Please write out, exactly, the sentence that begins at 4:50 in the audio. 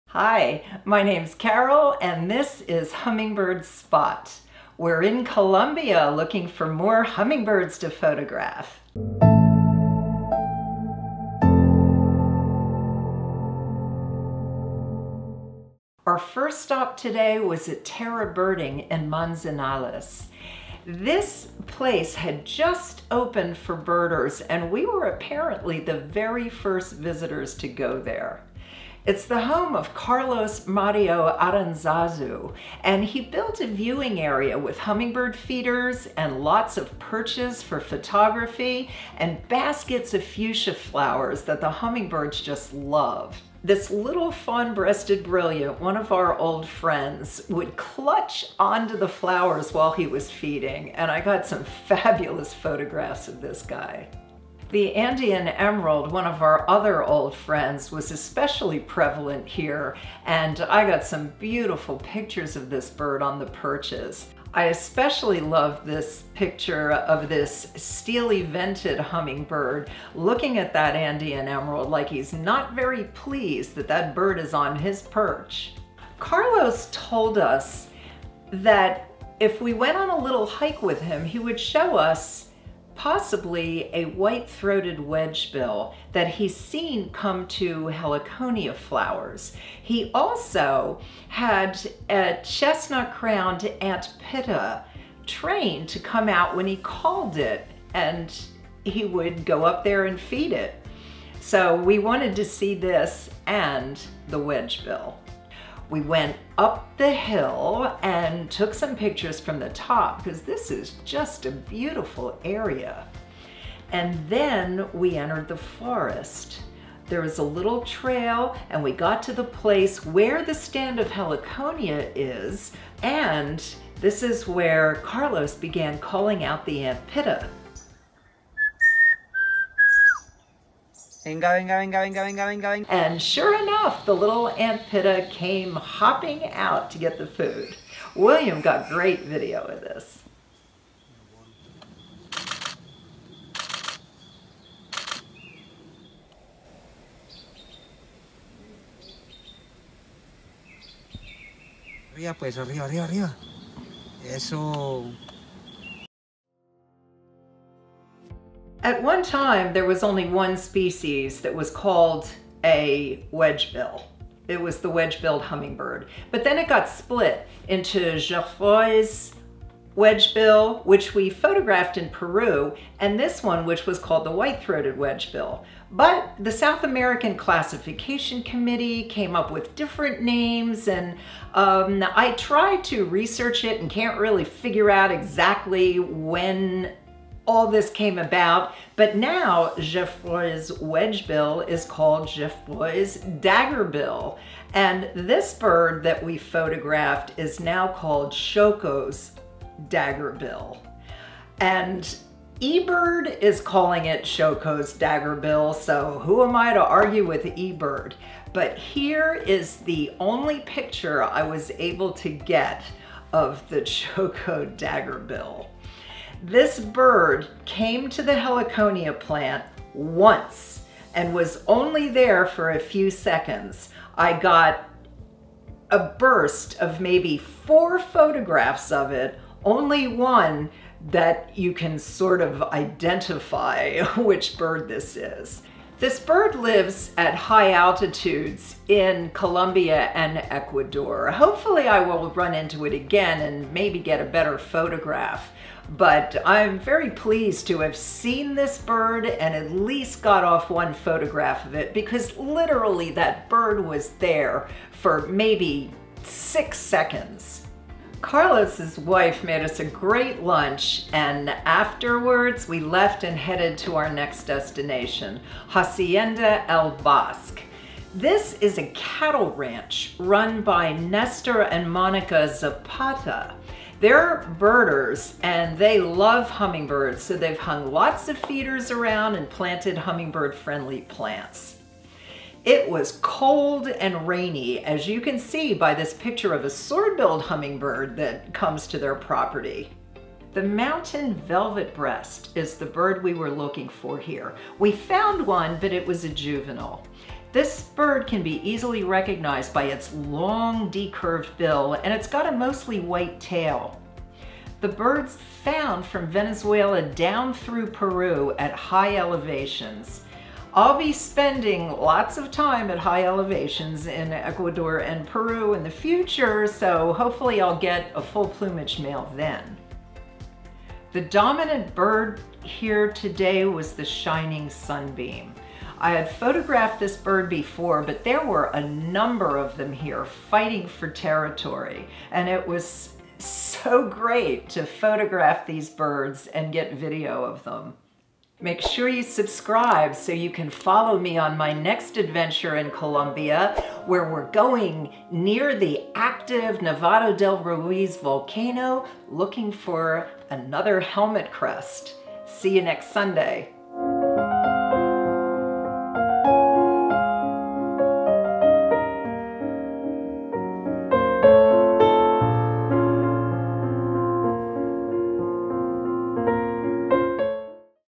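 The mountain velvet breast is the bird we were looking for here.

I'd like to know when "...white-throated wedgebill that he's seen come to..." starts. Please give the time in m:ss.
1:24.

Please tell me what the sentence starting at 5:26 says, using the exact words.
I had photographed this bird before, but there were a number of them here fighting for territory.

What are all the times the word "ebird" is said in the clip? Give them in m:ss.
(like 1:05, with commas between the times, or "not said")
3:22, 3:27.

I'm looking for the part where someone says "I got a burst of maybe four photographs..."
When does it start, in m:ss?
3:44.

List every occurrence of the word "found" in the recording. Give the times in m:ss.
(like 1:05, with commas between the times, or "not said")
4:54, 5:05.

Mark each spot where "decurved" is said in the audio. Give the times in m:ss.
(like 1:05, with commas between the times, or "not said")
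5:00.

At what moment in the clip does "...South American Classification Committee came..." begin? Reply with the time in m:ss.
2:56.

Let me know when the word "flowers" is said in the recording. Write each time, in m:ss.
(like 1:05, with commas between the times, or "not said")
0:40, 0:49, 1:28.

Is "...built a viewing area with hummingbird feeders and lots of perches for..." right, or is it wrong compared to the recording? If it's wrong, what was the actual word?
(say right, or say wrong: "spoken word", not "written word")
right.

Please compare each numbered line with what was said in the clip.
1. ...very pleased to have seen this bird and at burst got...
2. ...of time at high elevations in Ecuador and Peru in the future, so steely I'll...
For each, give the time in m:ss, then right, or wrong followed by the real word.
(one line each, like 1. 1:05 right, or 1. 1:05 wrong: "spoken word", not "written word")
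1. 4:06 wrong: "least", not "burst"
2. 5:12 wrong: "hopefully", not "steely".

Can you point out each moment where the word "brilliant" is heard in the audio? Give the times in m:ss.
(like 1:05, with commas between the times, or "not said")
0:45.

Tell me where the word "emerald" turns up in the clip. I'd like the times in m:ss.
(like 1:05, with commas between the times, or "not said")
0:55, 1:11.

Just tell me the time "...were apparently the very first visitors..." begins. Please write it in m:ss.
0:24.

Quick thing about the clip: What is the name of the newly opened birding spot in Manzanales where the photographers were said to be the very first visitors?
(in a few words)
Terra Birding.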